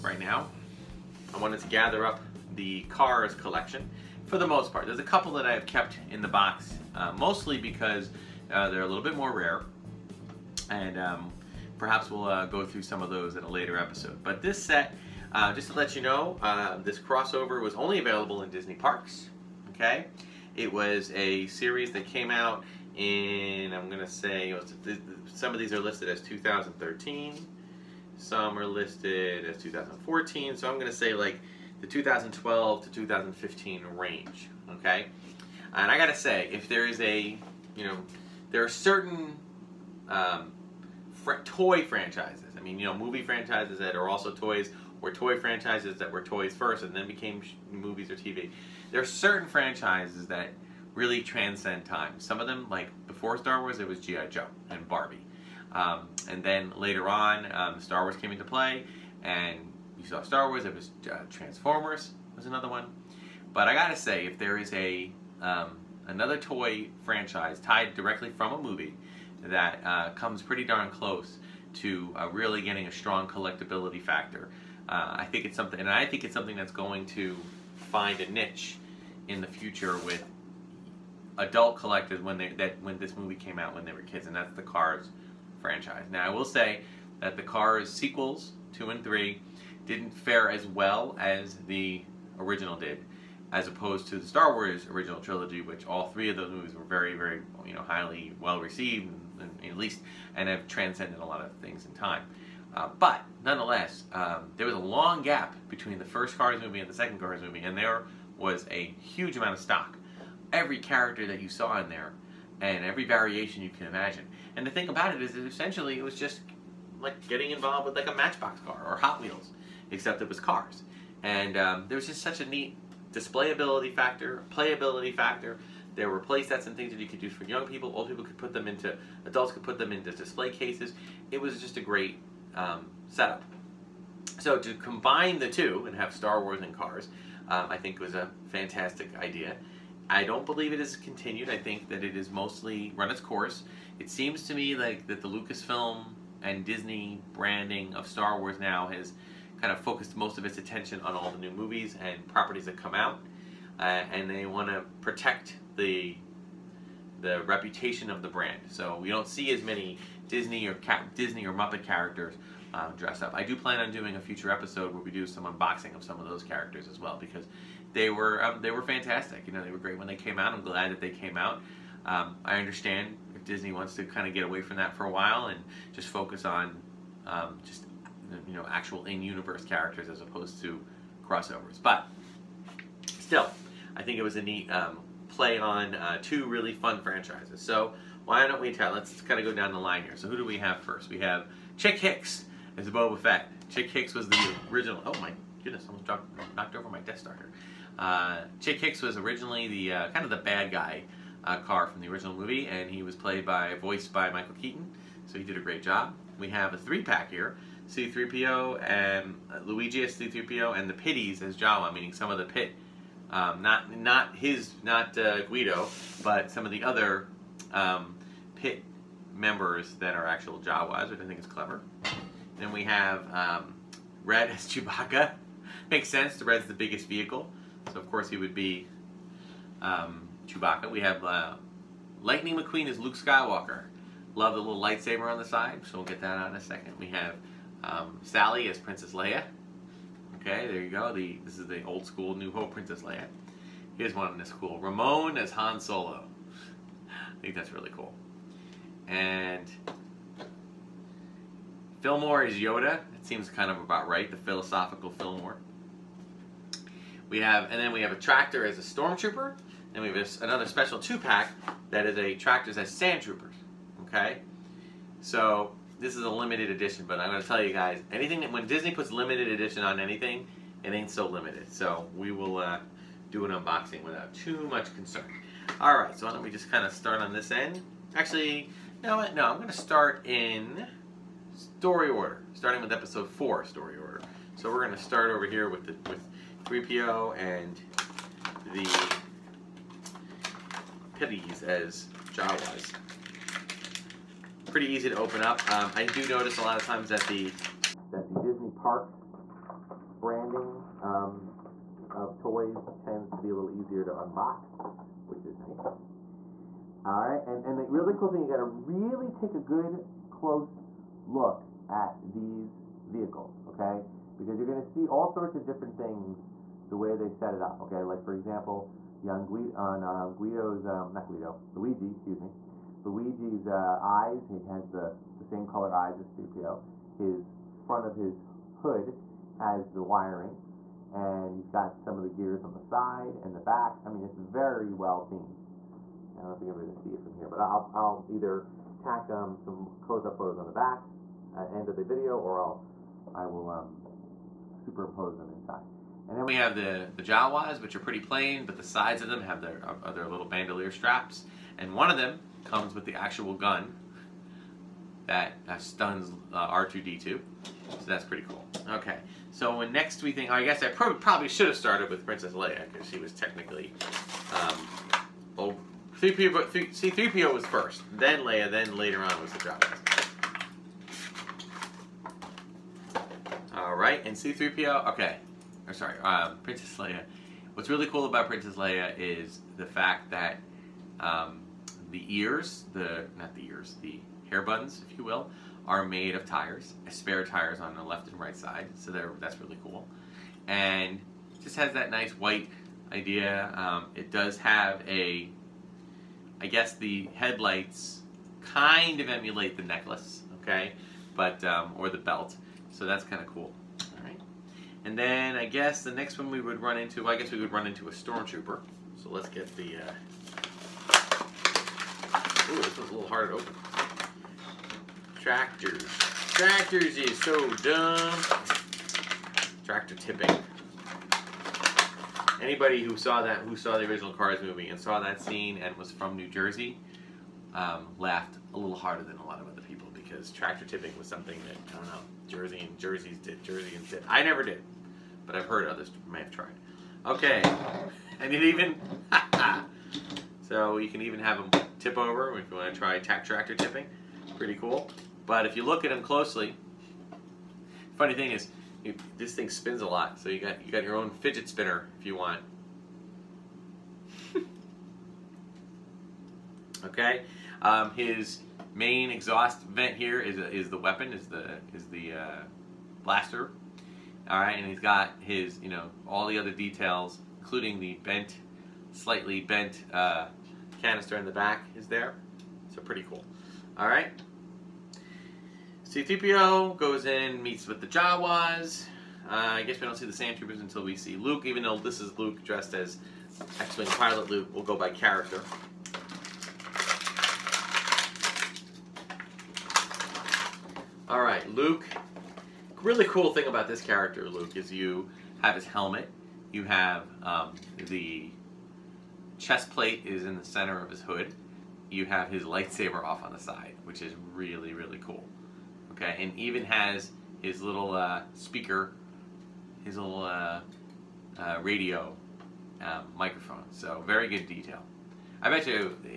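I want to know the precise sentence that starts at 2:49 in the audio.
You know, they were great when they came out.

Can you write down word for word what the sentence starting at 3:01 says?
But still, I think it was a neat um, play on uh, two really fun franchises.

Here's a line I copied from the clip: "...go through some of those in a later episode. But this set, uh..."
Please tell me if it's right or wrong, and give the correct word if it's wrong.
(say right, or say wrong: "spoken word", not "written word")
right.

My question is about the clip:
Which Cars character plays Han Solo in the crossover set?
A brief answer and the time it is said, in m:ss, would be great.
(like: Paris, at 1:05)
Ramon, at 4:04.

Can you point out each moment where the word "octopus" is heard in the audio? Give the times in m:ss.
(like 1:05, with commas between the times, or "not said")
not said.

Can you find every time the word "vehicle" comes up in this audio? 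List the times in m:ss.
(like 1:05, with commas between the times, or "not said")
3:47, 5:13.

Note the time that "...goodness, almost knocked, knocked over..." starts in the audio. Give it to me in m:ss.
3:15.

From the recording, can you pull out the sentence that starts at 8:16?
You have um, the chest plate is in the center of his hood.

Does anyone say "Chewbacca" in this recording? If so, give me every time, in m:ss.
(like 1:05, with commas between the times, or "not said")
3:44, 3:50.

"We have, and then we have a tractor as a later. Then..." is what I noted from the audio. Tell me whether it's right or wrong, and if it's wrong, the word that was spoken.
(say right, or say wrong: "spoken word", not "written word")
wrong: "stormtrooper", not "later".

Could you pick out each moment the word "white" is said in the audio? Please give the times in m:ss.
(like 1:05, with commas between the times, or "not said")
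6:32.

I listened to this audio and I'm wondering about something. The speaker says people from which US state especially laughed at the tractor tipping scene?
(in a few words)
New Jersey.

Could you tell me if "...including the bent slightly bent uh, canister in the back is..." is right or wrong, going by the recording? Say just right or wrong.
right.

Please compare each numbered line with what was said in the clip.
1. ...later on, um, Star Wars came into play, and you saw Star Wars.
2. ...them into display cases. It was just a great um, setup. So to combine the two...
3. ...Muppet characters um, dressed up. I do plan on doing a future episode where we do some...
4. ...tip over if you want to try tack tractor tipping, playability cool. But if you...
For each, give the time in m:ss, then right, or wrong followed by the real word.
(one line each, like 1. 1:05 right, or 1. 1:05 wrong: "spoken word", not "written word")
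1. 0:56 right
2. 2:09 right
3. 2:41 right
4. 7:21 wrong: "pretty", not "playability".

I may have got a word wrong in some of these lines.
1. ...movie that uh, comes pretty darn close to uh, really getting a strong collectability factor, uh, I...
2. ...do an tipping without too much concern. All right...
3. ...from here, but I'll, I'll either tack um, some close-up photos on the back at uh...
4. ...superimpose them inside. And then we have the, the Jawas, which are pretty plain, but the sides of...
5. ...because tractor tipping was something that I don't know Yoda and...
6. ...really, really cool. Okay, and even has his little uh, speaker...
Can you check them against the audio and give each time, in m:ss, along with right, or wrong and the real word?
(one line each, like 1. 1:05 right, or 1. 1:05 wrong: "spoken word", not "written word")
1. 1:08 right
2. 4:33 wrong: "unboxing", not "tipping"
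3. 5:37 right
4. 5:44 right
5. 7:10 wrong: "Jersey", not "Yoda"
6. 8:24 right.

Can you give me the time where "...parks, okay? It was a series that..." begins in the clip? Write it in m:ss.
0:18.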